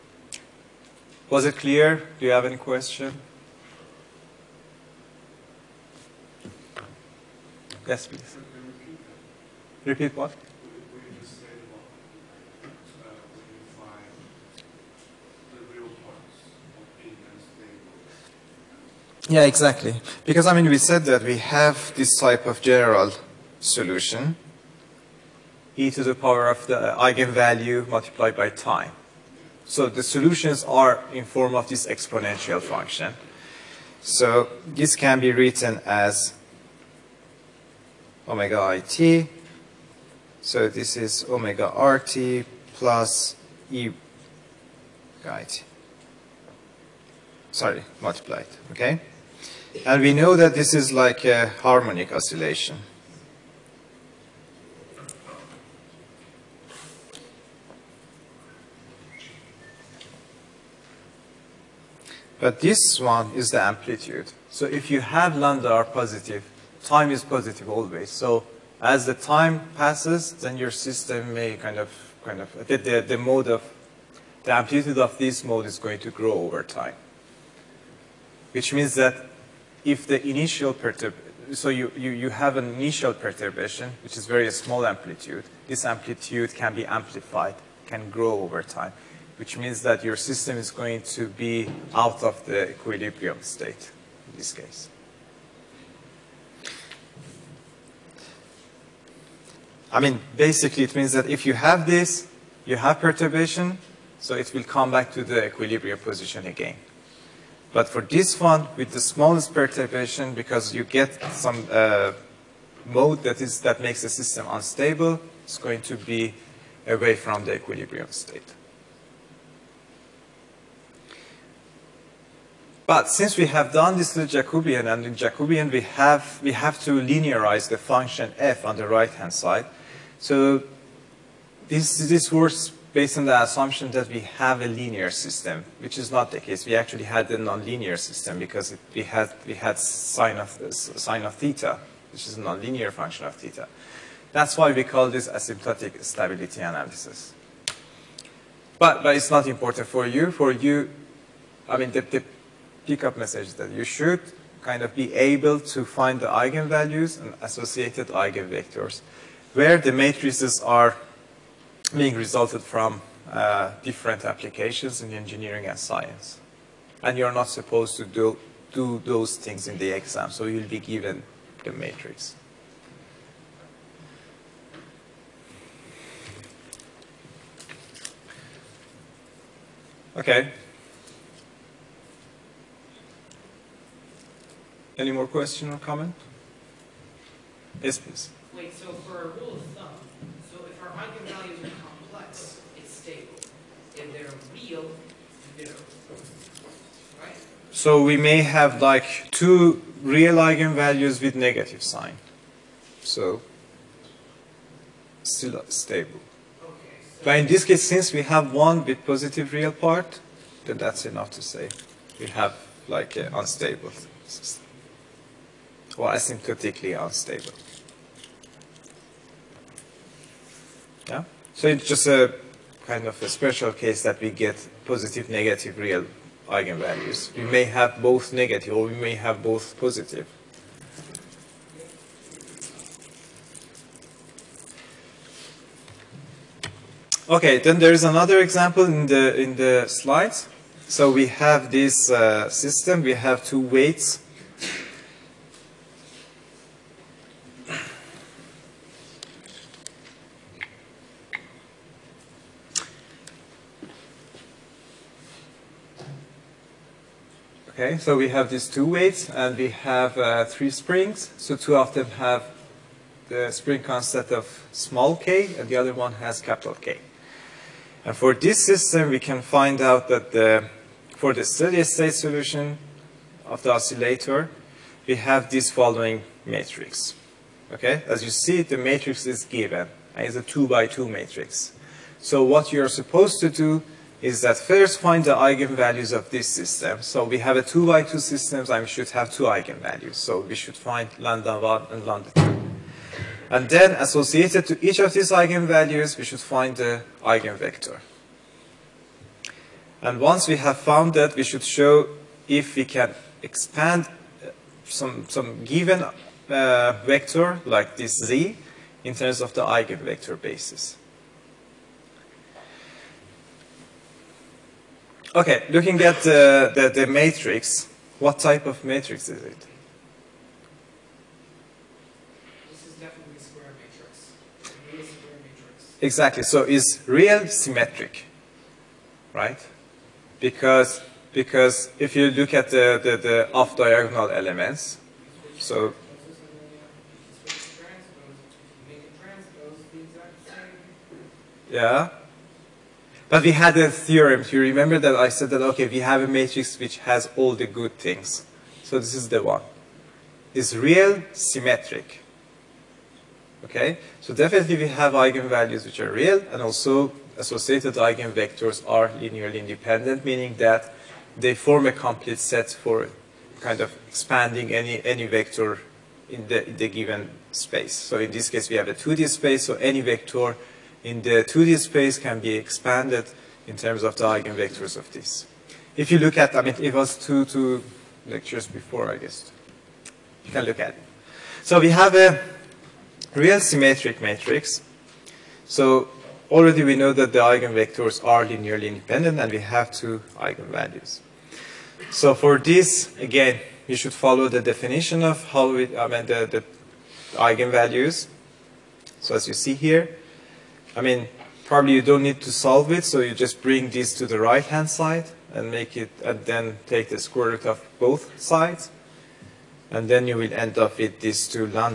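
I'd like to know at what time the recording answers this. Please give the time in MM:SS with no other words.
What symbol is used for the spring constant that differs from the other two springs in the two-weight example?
04:26.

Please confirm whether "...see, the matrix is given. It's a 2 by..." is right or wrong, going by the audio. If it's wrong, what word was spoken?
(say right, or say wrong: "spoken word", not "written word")
right.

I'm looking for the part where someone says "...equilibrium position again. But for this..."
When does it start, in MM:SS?
01:45.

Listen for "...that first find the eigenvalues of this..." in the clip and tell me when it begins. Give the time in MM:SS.
04:44.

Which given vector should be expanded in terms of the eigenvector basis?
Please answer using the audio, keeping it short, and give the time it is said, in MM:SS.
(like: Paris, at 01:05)
z, at 05:07.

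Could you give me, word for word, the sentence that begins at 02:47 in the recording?
And you're not supposed to do, do those things in the exam, so you'll be given the matrix.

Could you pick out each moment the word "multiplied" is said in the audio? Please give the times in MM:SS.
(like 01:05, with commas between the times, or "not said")
00:27, 00:48.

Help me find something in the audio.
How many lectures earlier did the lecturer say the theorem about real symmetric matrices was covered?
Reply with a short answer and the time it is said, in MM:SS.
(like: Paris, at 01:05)
2, at 06:17.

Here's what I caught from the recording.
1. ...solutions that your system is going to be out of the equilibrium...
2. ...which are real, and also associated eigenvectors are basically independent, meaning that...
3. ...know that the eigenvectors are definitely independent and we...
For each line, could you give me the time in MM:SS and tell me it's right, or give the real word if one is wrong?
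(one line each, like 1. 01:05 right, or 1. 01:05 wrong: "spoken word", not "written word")
1. 01:29 wrong: "means", not "solutions"
2. 05:55 wrong: "linearly", not "basically"
3. 06:26 wrong: "linearly", not "definitely".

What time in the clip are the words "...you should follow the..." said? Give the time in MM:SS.
06:33.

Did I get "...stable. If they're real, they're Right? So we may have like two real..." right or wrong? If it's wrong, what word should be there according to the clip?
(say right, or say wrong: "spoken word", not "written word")
right.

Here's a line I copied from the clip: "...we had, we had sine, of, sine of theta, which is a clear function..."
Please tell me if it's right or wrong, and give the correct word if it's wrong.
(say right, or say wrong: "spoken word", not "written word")
wrong: "nonlinear", not "clear".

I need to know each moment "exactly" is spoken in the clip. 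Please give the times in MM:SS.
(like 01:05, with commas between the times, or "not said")
00:19, 05:26.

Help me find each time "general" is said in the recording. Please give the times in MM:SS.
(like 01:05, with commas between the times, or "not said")
00:22.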